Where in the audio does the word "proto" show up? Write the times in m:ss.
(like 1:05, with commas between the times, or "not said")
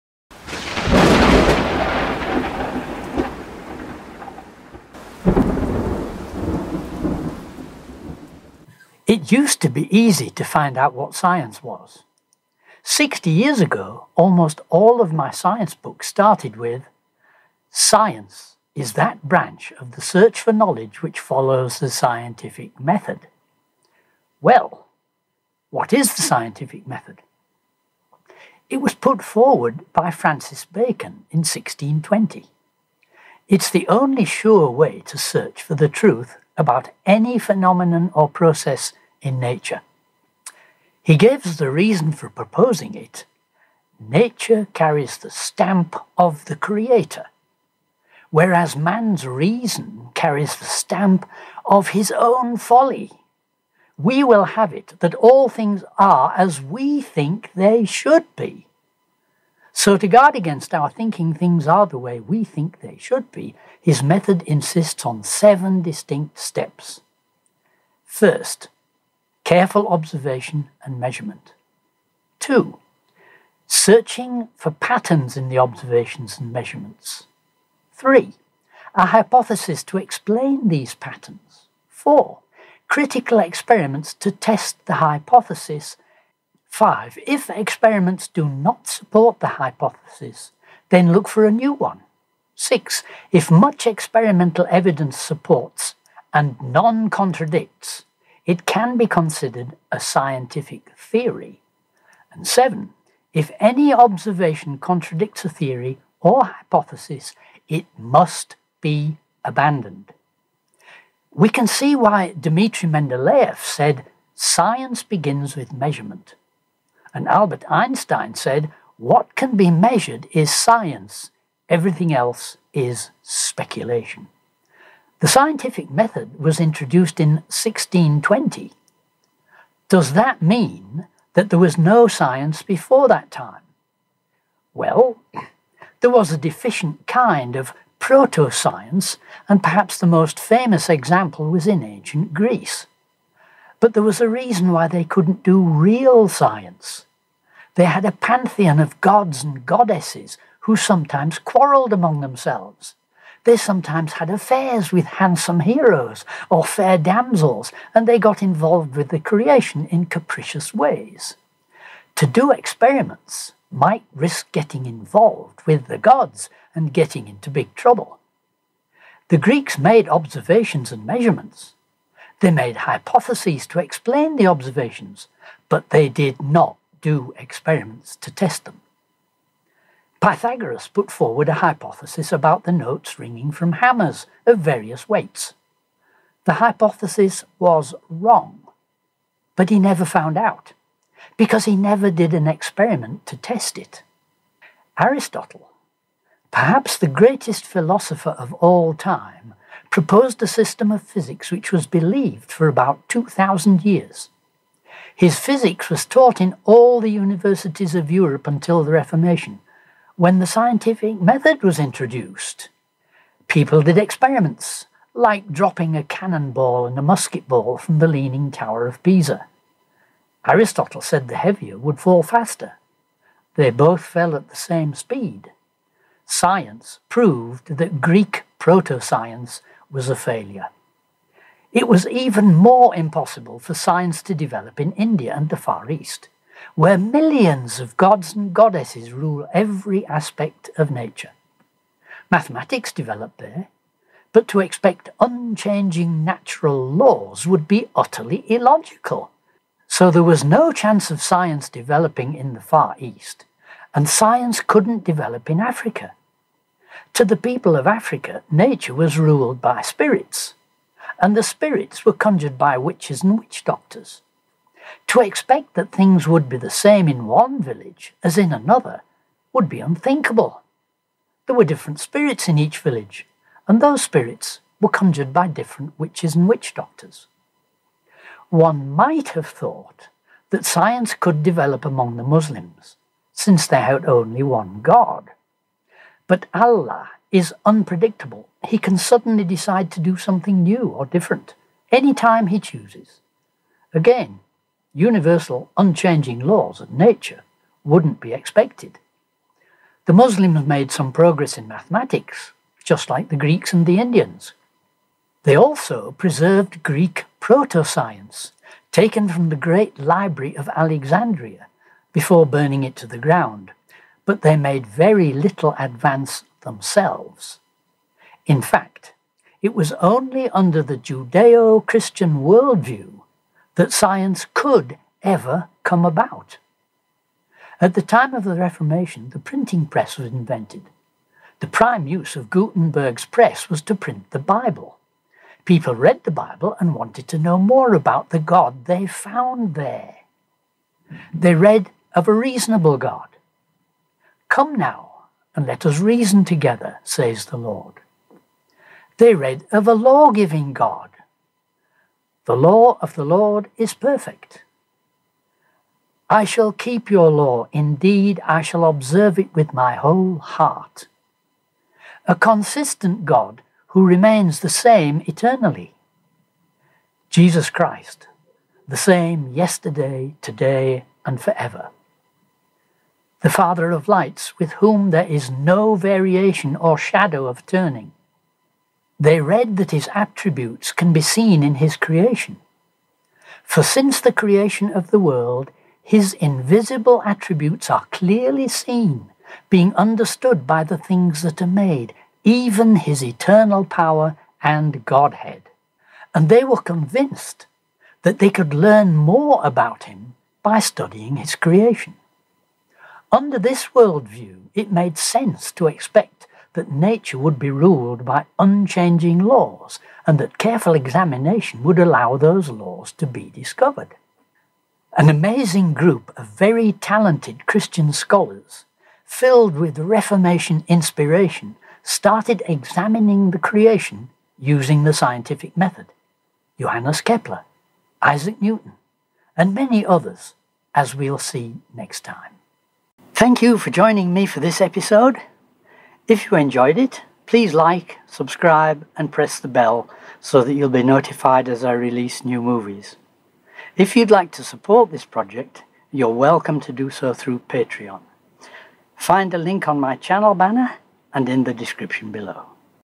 2:17, 3:48, 5:07.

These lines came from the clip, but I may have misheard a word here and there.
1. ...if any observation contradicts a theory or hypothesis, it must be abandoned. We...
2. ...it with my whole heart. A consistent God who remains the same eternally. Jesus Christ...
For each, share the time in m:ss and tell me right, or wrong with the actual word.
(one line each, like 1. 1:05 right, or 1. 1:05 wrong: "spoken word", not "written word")
1. 1:43 right
2. 5:59 right.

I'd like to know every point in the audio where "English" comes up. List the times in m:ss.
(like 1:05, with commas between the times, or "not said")
not said.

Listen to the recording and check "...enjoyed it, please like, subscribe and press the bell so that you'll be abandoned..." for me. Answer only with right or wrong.
wrong.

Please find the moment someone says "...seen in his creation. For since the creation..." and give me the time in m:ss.
6:21.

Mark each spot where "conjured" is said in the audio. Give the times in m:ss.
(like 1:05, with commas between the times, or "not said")
4:22, 4:34.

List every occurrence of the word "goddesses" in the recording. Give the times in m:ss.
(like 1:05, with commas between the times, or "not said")
2:29, 3:58.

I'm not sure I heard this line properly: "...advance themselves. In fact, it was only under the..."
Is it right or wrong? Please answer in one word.
right.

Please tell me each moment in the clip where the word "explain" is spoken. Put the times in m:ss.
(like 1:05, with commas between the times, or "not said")
1:19, 2:53.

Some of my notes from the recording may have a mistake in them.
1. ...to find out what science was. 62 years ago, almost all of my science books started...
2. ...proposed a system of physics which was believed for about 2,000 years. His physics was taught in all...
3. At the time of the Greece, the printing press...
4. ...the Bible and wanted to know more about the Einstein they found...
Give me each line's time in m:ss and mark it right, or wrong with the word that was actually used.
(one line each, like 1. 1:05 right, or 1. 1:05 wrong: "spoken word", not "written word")
1. 0:10 wrong: "60", not "62"
2. 3:19 right
3. 5:27 wrong: "Reformation", not "Greece"
4. 5:36 wrong: "God", not "Einstein".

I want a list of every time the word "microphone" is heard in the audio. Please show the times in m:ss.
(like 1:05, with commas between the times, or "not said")
not said.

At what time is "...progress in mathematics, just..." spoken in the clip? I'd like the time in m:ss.
5:01.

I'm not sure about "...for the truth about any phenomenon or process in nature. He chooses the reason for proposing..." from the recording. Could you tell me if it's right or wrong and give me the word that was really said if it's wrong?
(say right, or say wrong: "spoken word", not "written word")
wrong: "gives", not "chooses".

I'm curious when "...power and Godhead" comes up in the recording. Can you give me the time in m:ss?
6:33.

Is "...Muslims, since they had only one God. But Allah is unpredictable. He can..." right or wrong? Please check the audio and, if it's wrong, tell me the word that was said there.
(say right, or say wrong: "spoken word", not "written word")
right.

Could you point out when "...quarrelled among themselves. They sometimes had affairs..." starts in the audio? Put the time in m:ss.
2:31.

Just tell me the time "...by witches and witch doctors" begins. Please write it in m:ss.
4:22.